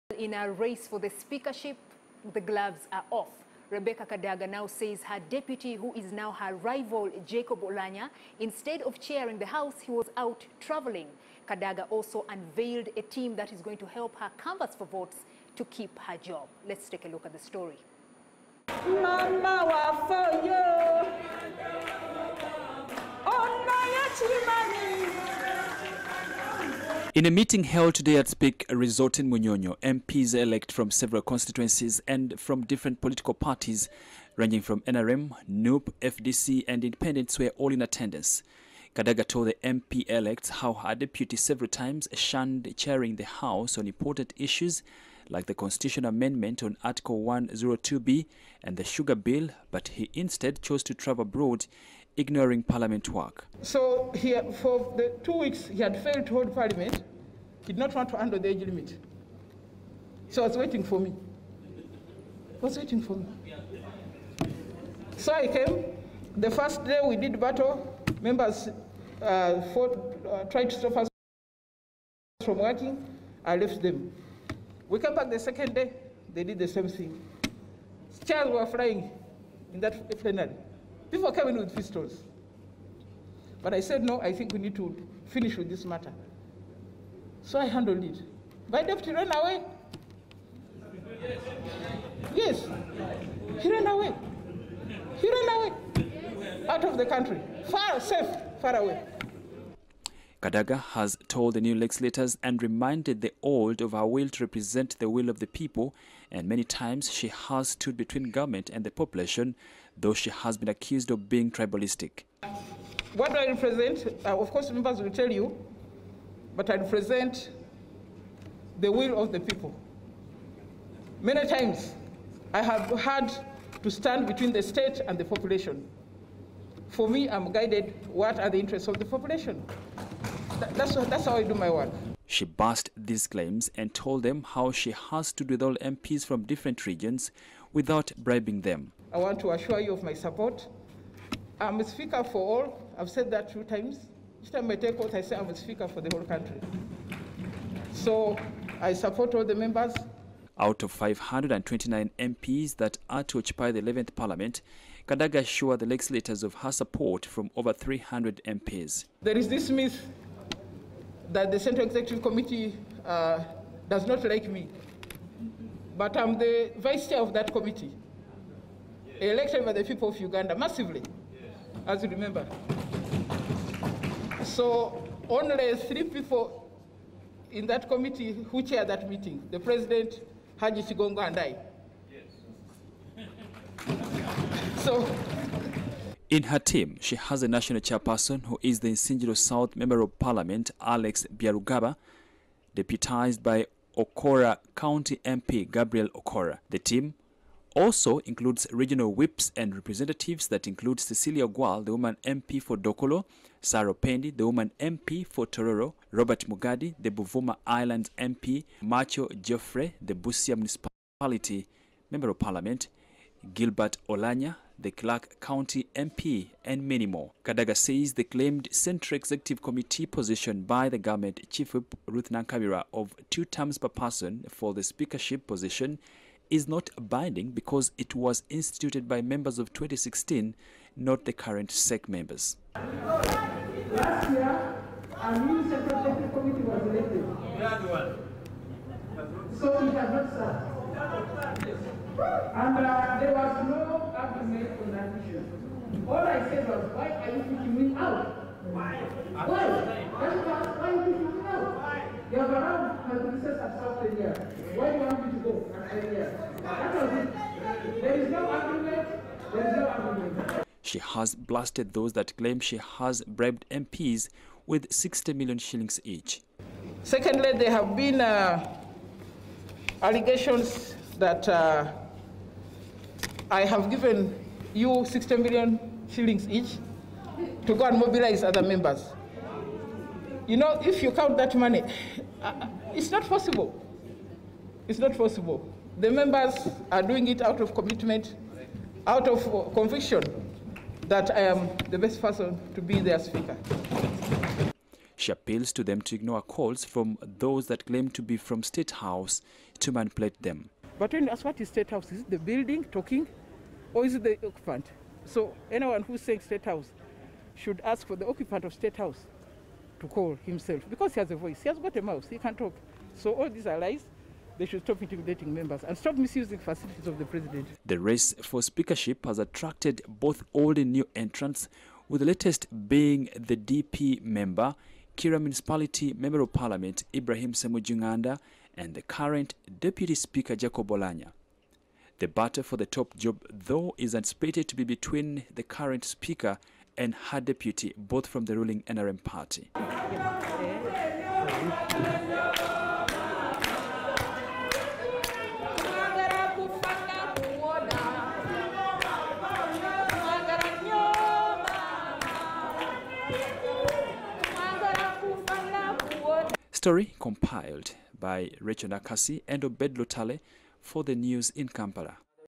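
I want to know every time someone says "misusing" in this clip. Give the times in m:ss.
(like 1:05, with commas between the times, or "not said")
5:16.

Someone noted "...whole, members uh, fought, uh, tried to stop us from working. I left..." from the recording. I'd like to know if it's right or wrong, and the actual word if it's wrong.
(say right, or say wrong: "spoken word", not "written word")
wrong: "battle", not "whole".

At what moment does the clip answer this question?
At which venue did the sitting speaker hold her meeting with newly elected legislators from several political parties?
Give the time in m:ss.
0:28.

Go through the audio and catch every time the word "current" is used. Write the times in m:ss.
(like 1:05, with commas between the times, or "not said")
3:51, 5:29, 5:35.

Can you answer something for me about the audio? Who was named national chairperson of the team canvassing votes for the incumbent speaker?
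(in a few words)
Alex Byarugaba.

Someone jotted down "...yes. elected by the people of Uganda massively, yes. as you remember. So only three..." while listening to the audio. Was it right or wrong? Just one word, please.
right.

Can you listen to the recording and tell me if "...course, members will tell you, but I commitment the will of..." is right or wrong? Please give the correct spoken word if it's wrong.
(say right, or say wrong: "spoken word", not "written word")
wrong: "represent", not "commitment".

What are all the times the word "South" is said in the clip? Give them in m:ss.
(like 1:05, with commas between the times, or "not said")
3:09, 4:13.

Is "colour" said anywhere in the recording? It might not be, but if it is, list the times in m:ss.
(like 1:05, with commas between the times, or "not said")
not said.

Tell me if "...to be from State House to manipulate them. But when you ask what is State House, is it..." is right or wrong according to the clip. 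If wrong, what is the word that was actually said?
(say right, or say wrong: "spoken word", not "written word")
right.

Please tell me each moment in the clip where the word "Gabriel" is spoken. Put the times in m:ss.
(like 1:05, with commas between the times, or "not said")
3:15.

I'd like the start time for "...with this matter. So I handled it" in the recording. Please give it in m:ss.
1:25.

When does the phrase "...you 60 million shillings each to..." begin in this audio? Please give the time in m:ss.
4:34.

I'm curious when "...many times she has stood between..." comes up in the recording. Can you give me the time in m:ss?
1:46.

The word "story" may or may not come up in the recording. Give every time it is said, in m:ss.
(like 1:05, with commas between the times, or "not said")
0:17, 5:56.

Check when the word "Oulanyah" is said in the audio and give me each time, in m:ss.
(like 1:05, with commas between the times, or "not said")
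0:07, 5:30.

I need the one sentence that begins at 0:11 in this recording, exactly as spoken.
Kadaga also unveiled a team that is going to help her canvass for votes to keep her job.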